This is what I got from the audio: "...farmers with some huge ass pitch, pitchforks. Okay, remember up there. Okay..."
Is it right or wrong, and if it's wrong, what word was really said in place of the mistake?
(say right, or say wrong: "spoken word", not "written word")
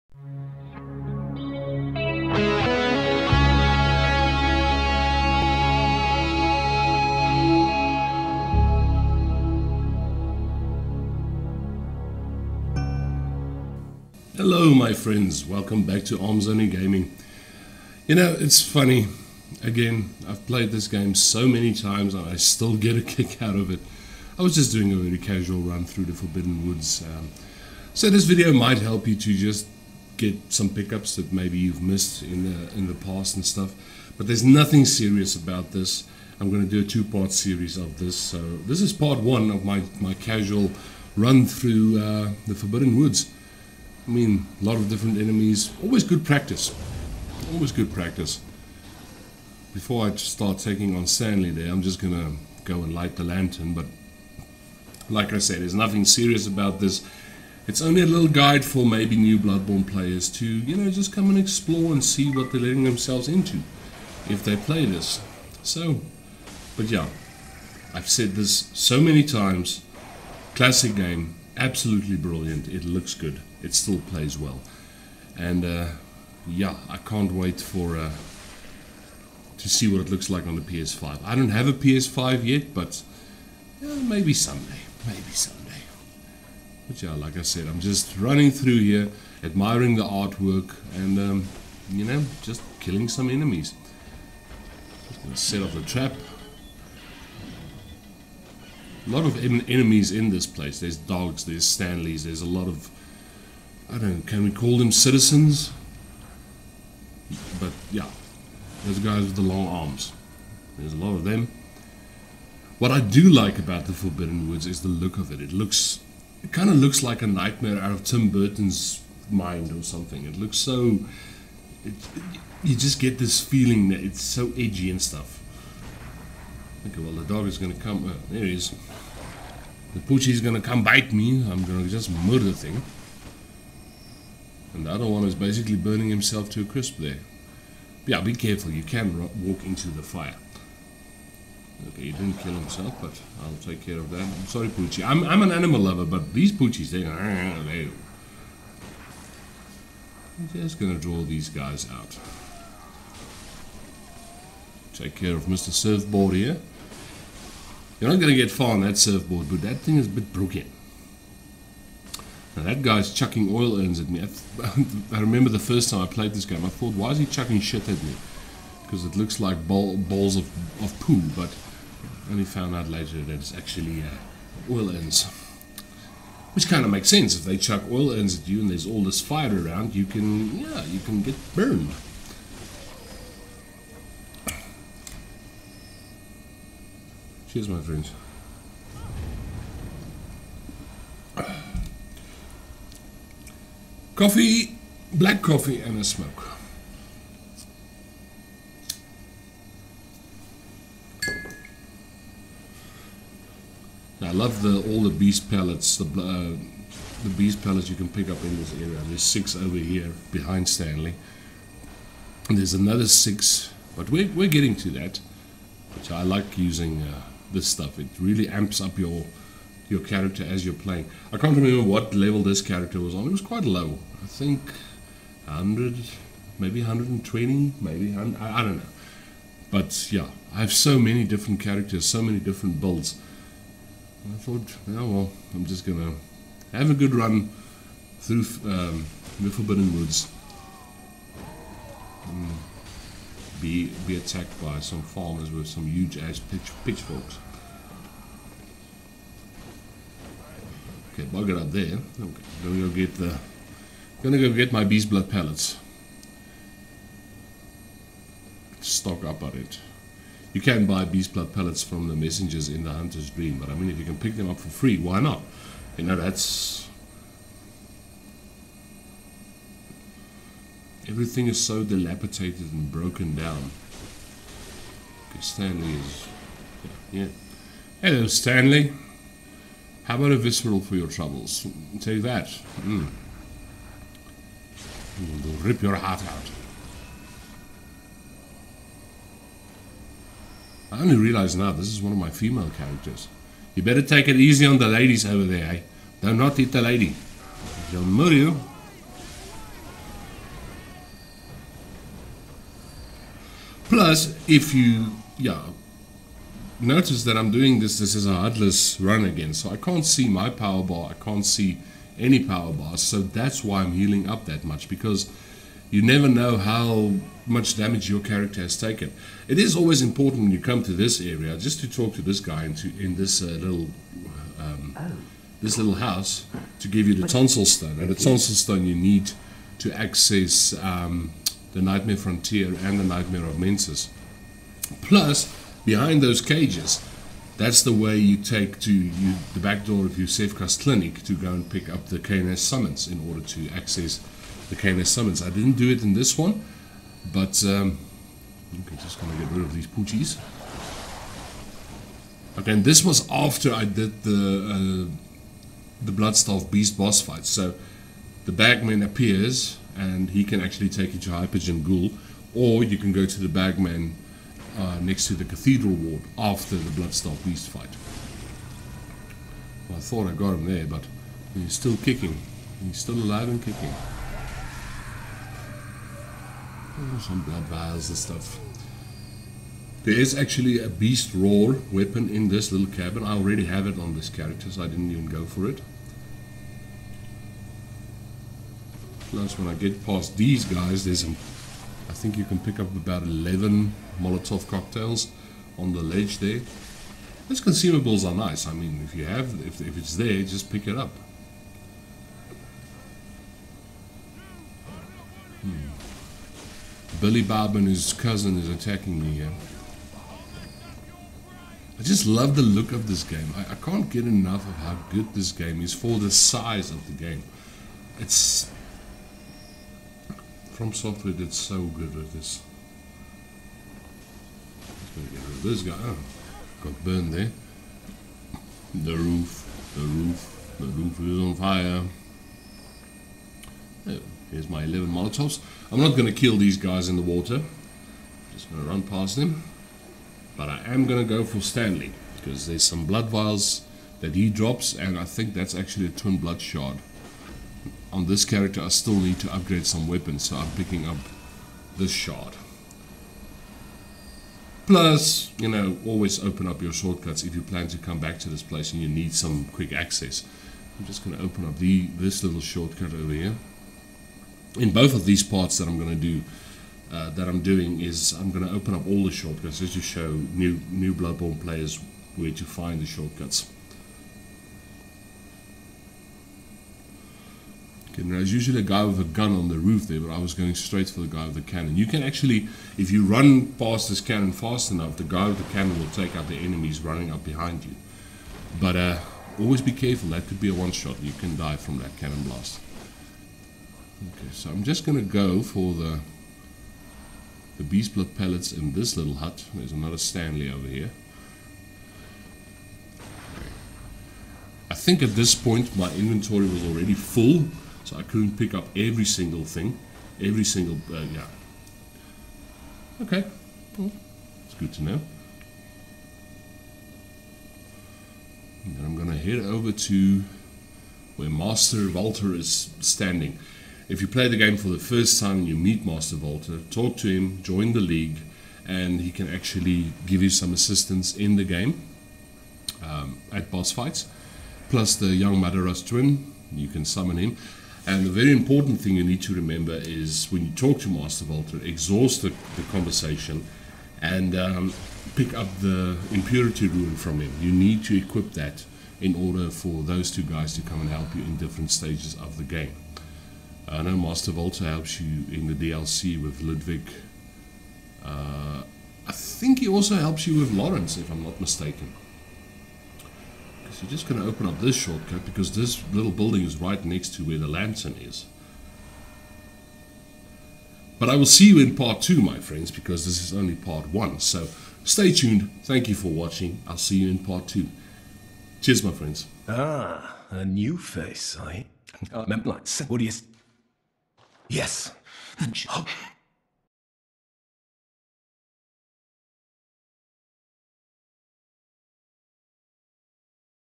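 wrong: "bugger", not "remember".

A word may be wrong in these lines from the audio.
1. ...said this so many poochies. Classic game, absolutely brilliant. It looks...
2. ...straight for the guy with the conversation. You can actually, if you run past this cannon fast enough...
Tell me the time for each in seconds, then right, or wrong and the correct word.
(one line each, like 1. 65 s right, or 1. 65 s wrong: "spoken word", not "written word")
1. 68 s wrong: "times", not "poochies"
2. 480 s wrong: "cannon", not "conversation".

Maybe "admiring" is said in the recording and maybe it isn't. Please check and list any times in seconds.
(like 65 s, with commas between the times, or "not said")
89 s.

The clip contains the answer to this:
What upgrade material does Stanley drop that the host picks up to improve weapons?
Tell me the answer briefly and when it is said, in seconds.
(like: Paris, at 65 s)
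Twin blood shard, at 446 s.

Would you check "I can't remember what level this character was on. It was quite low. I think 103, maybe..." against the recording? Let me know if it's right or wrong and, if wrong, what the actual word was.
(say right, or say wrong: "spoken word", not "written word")
wrong: "100", not "103".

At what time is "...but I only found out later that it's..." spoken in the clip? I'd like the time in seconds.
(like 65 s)
171 s.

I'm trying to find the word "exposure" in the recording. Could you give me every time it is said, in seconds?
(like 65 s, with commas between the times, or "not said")
not said.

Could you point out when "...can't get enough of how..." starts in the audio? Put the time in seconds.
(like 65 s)
413 s.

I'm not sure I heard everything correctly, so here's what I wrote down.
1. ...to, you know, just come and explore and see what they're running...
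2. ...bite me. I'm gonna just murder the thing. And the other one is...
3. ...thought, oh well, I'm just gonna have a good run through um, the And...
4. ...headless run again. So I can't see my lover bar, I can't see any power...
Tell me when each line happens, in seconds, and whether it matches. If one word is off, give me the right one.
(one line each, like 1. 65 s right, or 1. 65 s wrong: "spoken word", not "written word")
1. 60 s wrong: "letting", not "running"
2. 130 s right
3. 234 s wrong: "Forbidden", not "And"
4. 308 s wrong: "power", not "lover".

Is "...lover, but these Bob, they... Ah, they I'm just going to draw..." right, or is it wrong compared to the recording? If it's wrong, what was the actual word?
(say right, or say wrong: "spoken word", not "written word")
wrong: "Poochies", not "Bob".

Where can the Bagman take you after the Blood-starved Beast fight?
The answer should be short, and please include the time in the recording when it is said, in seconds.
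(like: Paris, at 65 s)
Hypogean Gaol, at 361 s.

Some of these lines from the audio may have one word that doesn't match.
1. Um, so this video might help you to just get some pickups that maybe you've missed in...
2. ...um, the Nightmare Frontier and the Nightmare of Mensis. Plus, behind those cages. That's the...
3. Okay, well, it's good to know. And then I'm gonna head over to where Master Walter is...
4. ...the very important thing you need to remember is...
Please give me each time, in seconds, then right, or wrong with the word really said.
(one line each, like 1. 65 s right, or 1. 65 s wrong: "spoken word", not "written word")
1. 27 s right
2. 330 s right
3. 513 s right
4. 538 s right.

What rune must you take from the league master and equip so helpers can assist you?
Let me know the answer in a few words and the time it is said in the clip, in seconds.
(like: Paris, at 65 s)
Impurity rune, at 546 s.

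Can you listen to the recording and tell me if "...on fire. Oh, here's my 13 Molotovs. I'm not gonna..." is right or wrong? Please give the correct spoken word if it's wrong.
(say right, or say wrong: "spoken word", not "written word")
wrong: "11", not "13".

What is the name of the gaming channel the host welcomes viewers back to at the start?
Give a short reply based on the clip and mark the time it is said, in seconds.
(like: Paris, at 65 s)
Arms Only Gaming, at 16 s.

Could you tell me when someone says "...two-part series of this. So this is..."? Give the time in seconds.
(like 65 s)
36 s.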